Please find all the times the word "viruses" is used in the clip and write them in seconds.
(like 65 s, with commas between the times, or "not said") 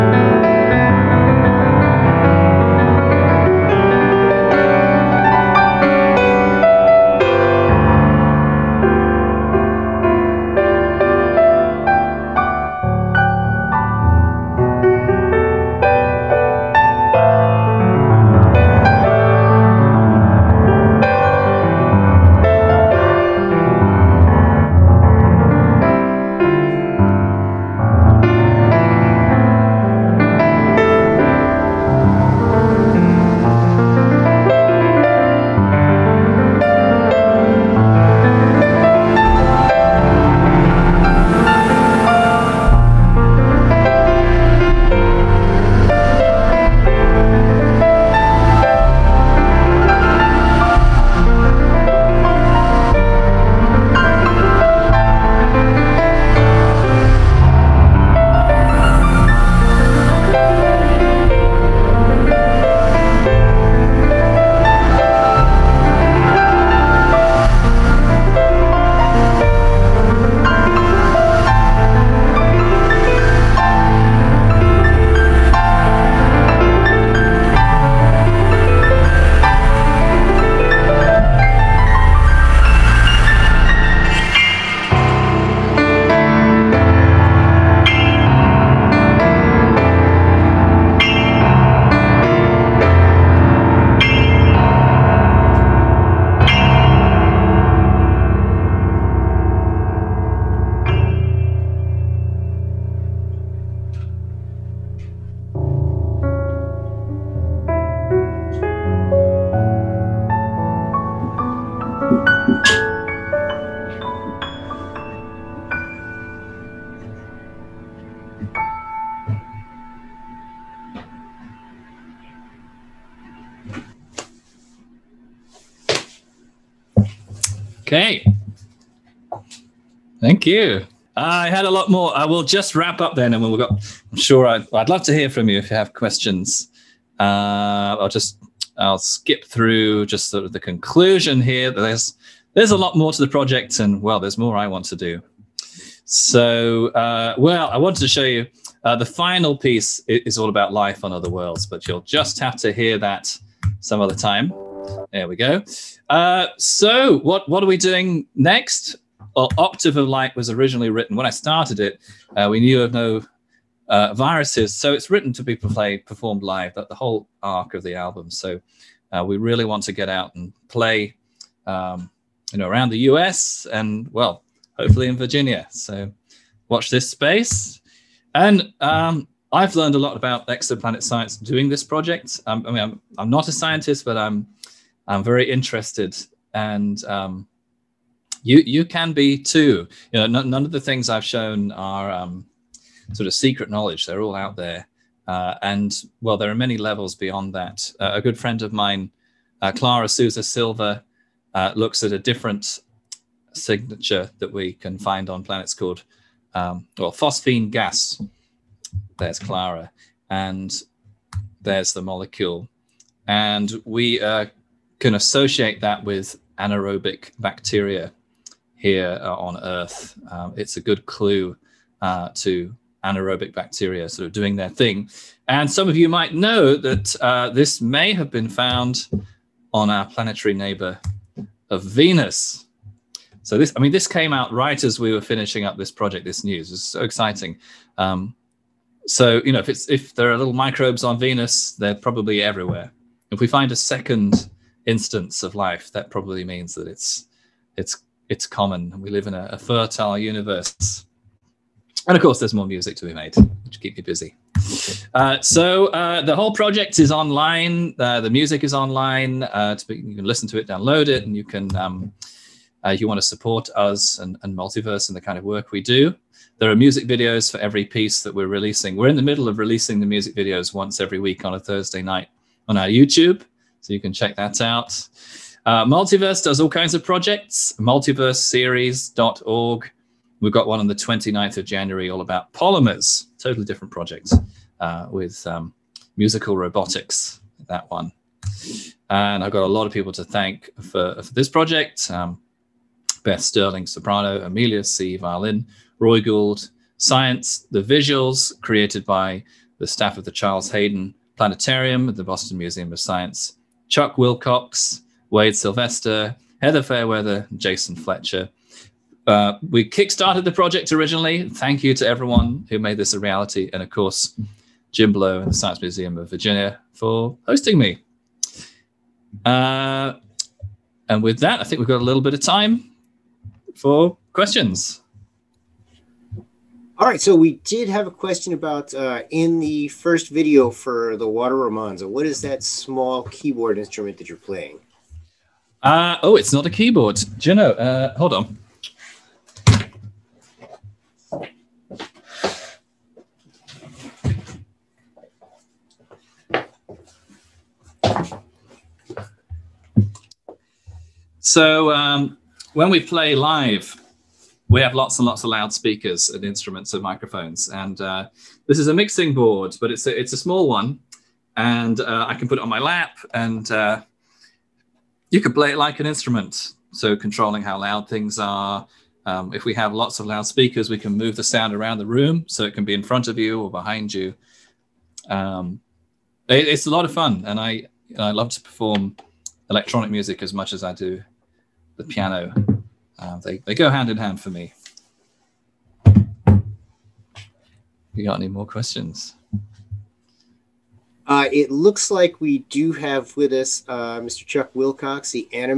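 164 s.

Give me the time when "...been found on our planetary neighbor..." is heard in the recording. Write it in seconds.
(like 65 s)
228 s.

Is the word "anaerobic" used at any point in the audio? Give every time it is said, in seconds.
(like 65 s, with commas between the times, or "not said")
216 s, 223 s.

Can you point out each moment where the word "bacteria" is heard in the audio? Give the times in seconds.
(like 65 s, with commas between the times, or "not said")
217 s, 223 s.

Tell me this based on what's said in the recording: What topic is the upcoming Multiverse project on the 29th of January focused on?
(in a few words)
Polymers.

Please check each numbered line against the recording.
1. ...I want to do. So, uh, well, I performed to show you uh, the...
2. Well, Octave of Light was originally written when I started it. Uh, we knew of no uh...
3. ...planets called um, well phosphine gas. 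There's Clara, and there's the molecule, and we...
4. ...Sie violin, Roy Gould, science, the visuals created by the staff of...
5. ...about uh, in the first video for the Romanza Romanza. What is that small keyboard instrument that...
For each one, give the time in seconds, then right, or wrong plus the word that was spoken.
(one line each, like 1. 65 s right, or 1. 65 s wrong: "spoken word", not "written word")
1. 144 s wrong: "wanted", not "performed"
2. 159 s right
3. 205 s right
4. 294 s right
5. 328 s wrong: "Water", not "Romanza".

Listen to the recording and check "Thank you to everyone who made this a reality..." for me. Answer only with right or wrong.
right.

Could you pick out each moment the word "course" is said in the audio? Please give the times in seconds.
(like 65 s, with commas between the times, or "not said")
252 s, 313 s.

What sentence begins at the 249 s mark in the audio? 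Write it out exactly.
We live in a, a fertile universe.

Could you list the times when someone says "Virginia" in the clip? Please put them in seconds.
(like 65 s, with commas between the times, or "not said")
175 s, 316 s.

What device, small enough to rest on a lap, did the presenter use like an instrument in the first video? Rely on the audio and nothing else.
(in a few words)
Mixing board.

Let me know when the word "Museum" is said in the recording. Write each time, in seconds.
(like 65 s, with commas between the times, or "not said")
302 s, 315 s.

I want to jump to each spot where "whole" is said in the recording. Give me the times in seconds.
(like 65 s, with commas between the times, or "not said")
166 s, 256 s.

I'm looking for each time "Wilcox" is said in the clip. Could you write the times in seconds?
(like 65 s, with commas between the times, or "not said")
304 s, 394 s.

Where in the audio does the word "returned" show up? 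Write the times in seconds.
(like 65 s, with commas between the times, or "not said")
not said.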